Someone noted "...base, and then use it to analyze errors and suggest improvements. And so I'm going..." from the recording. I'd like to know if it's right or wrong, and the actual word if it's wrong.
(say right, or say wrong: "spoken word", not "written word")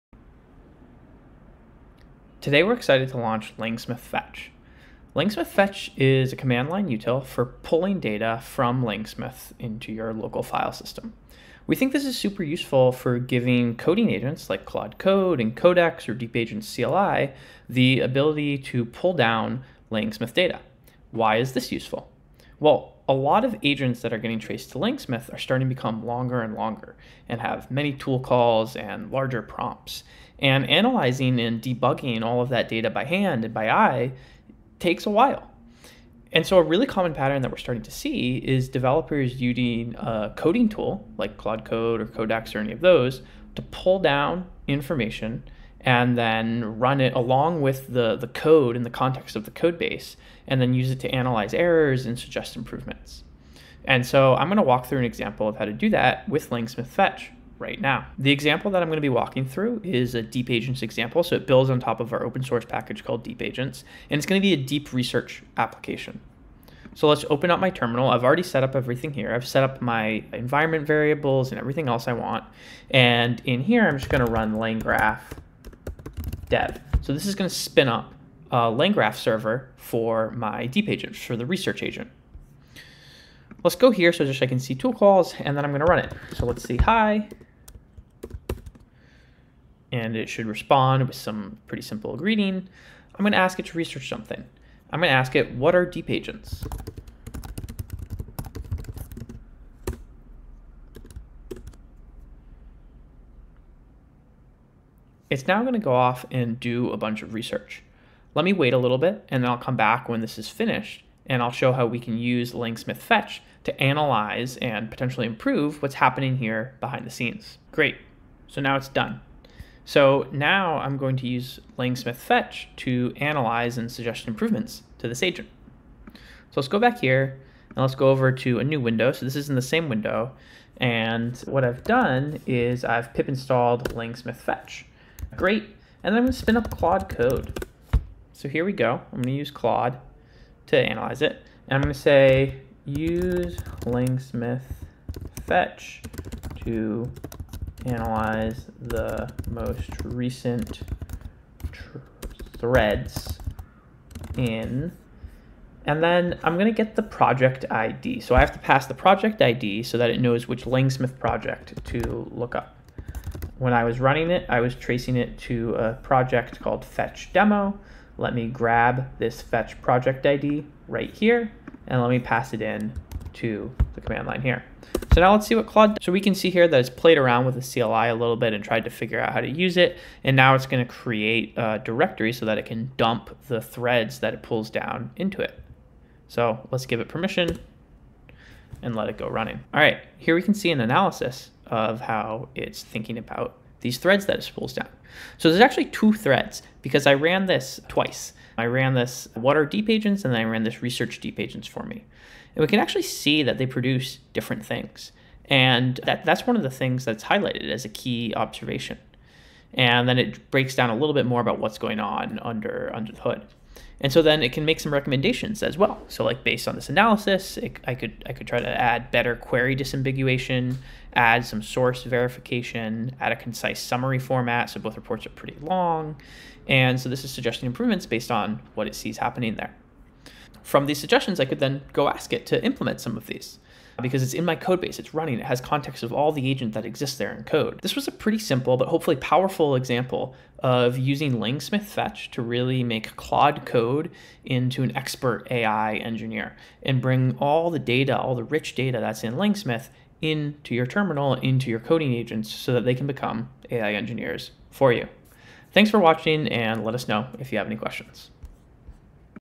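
right.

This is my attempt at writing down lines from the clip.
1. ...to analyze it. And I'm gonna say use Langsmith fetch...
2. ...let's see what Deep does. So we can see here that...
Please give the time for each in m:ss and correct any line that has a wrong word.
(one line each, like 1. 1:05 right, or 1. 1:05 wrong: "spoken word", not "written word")
1. 2:20 right
2. 2:55 wrong: "Claude", not "Deep".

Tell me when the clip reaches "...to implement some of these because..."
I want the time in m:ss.
3:52.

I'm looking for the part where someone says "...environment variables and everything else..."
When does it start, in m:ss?
1:10.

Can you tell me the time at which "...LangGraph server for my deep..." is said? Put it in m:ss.
1:18.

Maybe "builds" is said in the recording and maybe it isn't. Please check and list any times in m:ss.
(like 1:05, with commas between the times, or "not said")
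1:01.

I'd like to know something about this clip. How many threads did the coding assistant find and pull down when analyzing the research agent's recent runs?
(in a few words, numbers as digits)
2.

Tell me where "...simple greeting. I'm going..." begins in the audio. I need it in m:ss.
1:31.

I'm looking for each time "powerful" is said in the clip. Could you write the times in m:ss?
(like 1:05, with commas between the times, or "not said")
3:59.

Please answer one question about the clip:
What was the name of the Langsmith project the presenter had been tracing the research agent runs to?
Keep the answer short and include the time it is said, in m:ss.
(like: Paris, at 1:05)
fetch demo, at 2:46.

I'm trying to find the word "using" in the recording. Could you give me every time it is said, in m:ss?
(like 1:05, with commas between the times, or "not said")
0:39, 4:00.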